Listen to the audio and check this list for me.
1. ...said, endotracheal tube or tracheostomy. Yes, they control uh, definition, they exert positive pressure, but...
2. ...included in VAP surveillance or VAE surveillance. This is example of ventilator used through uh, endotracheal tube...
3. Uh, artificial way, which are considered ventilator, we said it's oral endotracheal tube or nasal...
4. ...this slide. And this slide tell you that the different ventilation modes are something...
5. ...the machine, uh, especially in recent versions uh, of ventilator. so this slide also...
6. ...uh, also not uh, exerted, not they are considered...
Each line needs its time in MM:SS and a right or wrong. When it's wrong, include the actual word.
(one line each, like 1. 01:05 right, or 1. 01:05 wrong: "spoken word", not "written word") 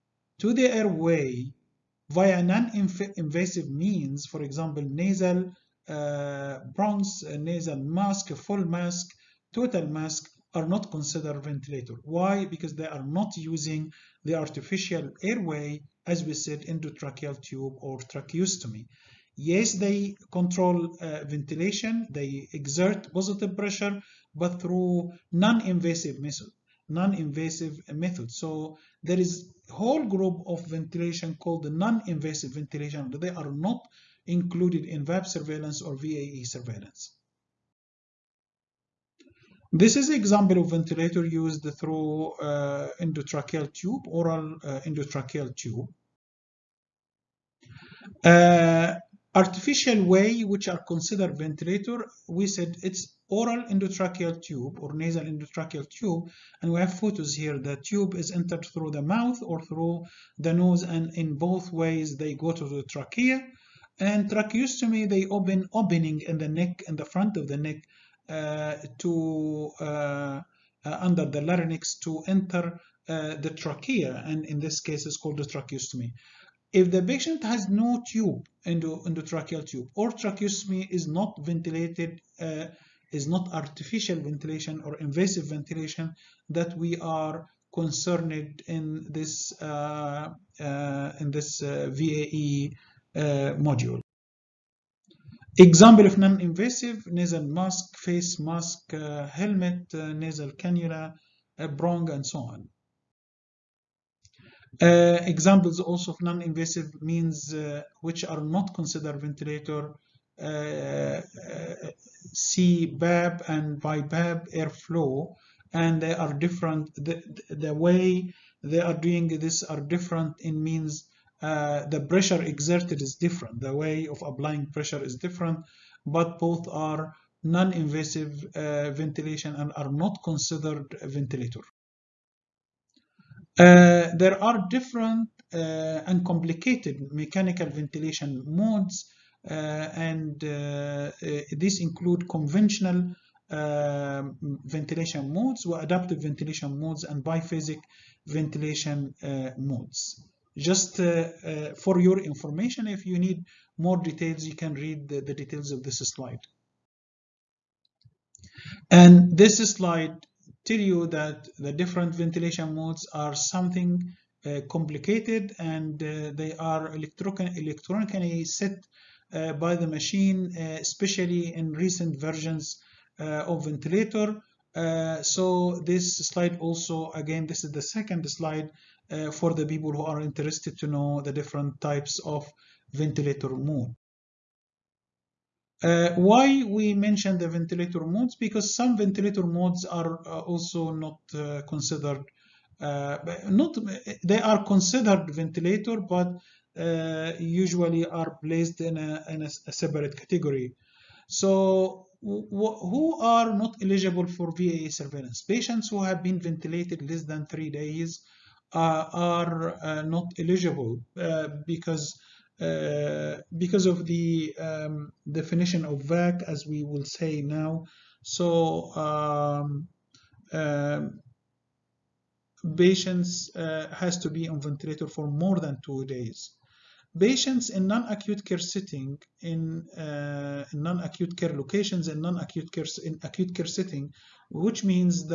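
1. 00:16 wrong: "ventilation", not "definition"
2. 00:34 right
3. 00:48 right
4. 02:35 right
5. 02:49 right
6. 03:10 wrong: "considered", not "exerted".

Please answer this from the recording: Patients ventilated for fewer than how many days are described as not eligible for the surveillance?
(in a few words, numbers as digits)
3.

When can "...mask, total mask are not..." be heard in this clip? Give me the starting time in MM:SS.
00:08.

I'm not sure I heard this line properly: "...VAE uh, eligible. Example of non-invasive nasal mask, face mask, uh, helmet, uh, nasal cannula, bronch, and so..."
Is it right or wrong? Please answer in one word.
wrong.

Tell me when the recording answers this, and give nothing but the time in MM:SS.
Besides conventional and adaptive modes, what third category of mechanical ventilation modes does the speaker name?
02:27.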